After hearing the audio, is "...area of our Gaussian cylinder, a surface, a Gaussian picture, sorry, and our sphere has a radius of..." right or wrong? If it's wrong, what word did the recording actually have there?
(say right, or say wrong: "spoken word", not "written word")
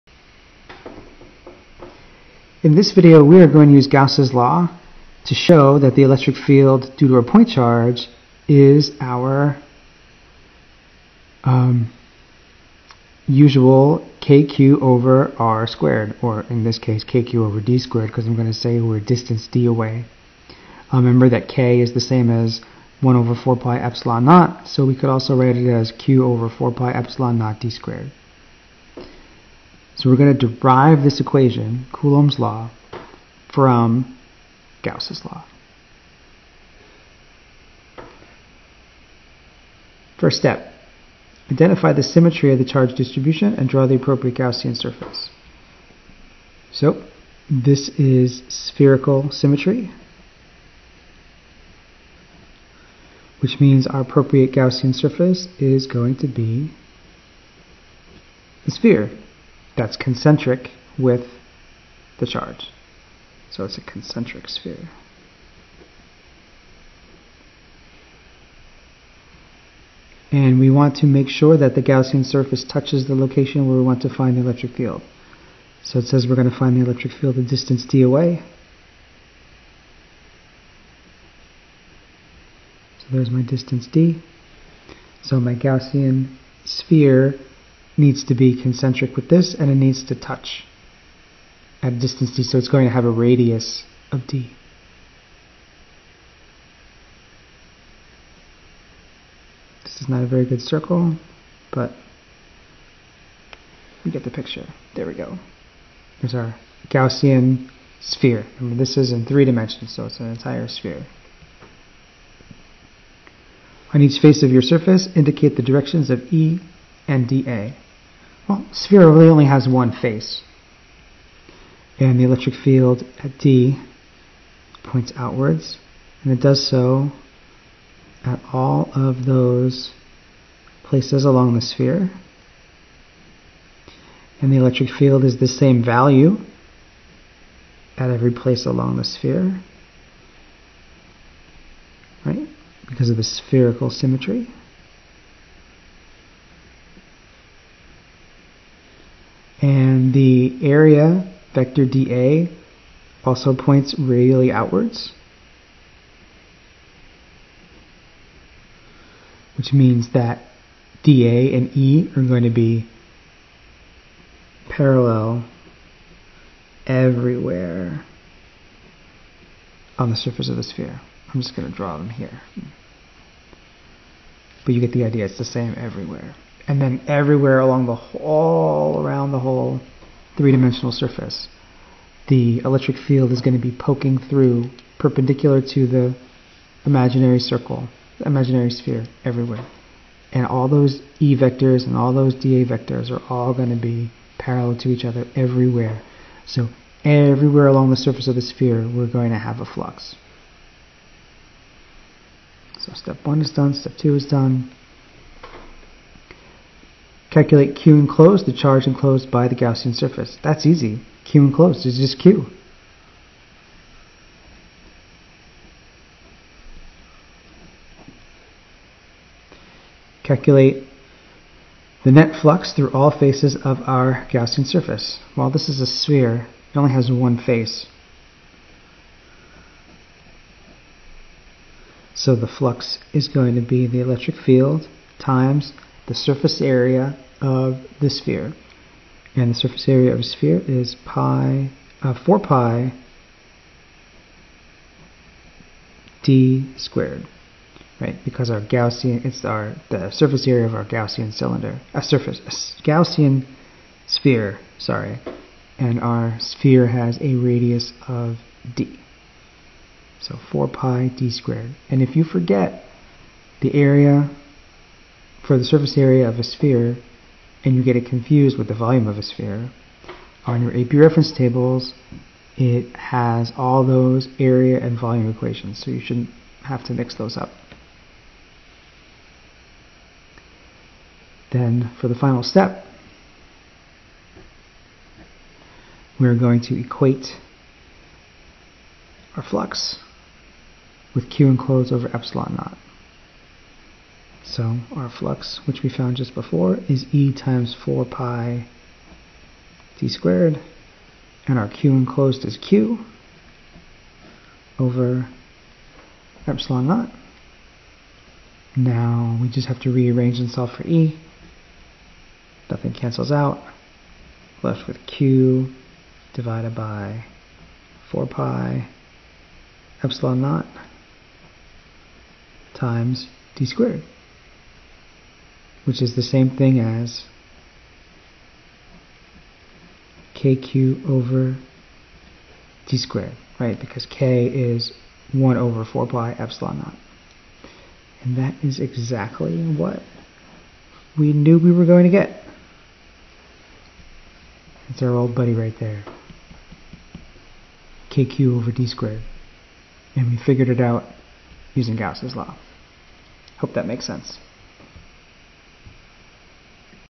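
wrong: "sphere", not "picture".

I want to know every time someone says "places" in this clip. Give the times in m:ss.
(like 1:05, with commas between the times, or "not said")
2:10, 2:18.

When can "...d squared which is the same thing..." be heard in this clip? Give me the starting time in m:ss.
5:23.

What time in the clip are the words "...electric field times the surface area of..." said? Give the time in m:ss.
3:54.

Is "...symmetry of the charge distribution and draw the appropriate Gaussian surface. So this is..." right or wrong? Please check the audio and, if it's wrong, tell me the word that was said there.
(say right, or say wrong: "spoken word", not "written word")
right.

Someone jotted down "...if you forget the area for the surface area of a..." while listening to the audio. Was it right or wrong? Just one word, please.
right.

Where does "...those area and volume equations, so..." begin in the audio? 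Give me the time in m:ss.
4:33.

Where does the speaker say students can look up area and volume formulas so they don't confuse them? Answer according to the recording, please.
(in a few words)
AP reference tables.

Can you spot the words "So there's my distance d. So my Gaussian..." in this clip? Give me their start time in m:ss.
1:22.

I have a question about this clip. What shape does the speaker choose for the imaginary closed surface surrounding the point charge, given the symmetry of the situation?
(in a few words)
Concentric sphere.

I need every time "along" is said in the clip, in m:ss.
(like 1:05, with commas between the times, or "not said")
2:11, 2:18, 2:57, 3:17.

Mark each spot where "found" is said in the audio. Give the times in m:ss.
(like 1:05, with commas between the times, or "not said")
4:55.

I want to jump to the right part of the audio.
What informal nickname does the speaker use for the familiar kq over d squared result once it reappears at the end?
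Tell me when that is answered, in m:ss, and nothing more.
5:45.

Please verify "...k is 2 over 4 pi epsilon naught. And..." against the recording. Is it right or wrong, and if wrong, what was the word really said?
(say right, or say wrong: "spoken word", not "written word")
wrong: "1", not "2".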